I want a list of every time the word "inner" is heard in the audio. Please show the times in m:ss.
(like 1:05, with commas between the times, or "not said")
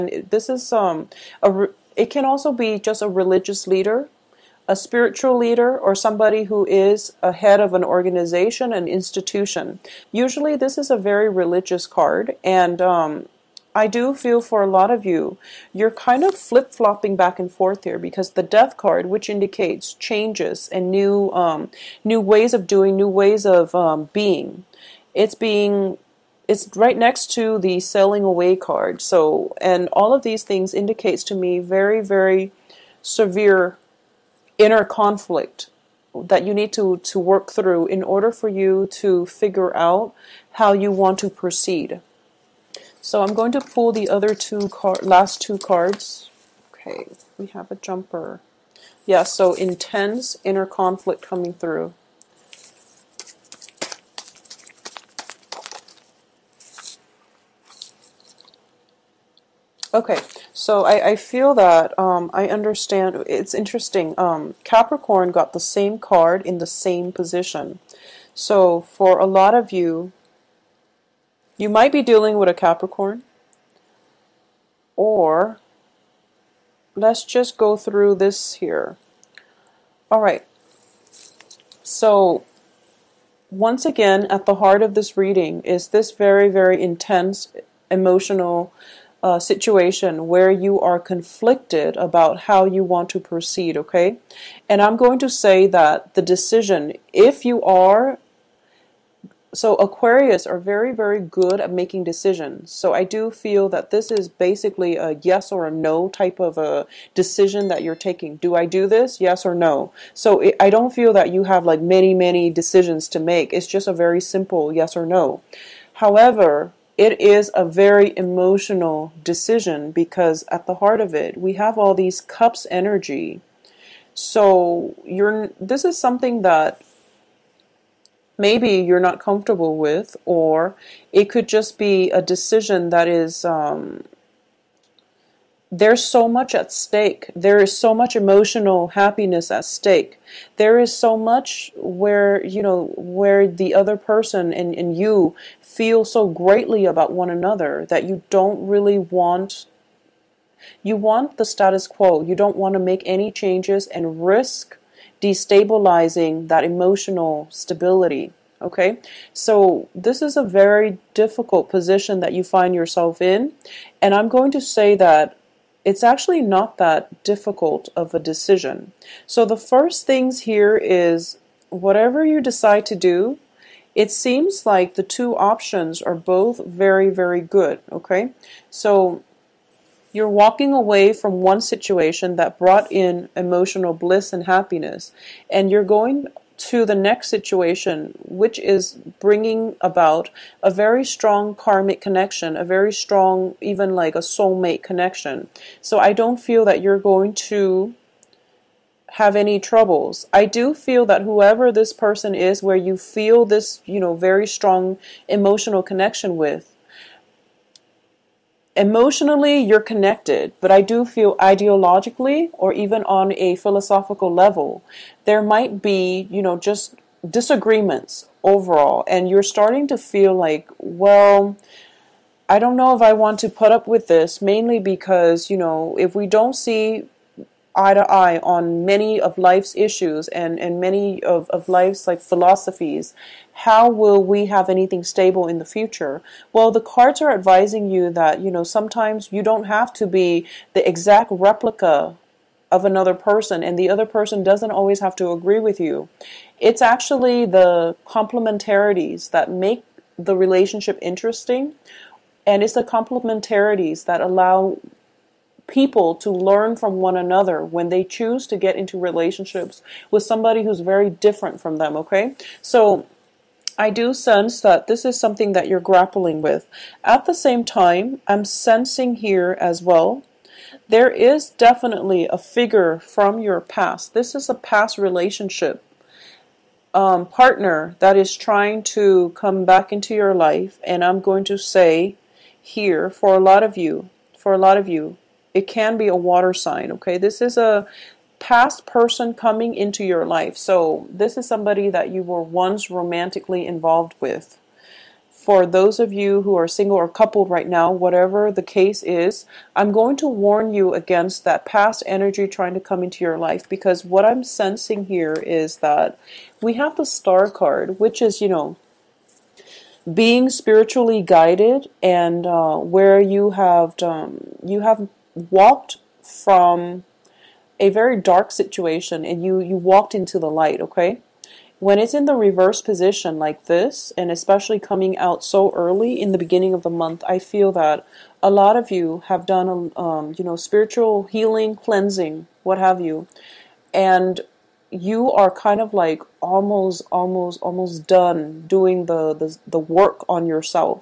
0:34, 0:50.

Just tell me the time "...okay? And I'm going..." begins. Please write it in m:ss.
1:33.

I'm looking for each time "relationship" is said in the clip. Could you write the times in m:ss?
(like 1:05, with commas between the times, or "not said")
4:10, 4:18, 4:34.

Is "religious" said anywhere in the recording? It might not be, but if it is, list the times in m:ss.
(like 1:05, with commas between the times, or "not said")
0:03, 0:11.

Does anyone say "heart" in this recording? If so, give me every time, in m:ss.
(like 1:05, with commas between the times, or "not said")
1:24, 2:00.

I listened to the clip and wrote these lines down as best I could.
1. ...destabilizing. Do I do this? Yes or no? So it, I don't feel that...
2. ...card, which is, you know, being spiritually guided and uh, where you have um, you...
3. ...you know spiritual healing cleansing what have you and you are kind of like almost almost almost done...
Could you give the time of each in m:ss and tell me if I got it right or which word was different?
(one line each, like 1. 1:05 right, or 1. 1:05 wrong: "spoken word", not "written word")
1. 1:47 wrong: "taking", not "destabilizing"
2. 5:07 right
3. 5:30 right.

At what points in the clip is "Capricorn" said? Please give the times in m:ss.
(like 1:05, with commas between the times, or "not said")
1:04, 1:12.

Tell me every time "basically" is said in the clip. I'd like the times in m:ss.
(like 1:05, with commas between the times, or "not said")
1:44.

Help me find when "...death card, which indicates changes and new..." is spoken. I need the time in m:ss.
0:18.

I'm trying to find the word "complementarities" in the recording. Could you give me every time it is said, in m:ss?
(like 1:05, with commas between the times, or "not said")
4:08, 4:12.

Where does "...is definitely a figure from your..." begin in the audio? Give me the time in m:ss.
4:31.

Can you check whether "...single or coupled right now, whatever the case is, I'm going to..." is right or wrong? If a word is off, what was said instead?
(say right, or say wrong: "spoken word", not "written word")
right.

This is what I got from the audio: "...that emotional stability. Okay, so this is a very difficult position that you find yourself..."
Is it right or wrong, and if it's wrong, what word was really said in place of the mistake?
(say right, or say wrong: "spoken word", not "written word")
right.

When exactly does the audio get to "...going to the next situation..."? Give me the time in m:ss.
3:05.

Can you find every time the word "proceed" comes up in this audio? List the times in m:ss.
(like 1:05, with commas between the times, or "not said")
0:41, 1:33.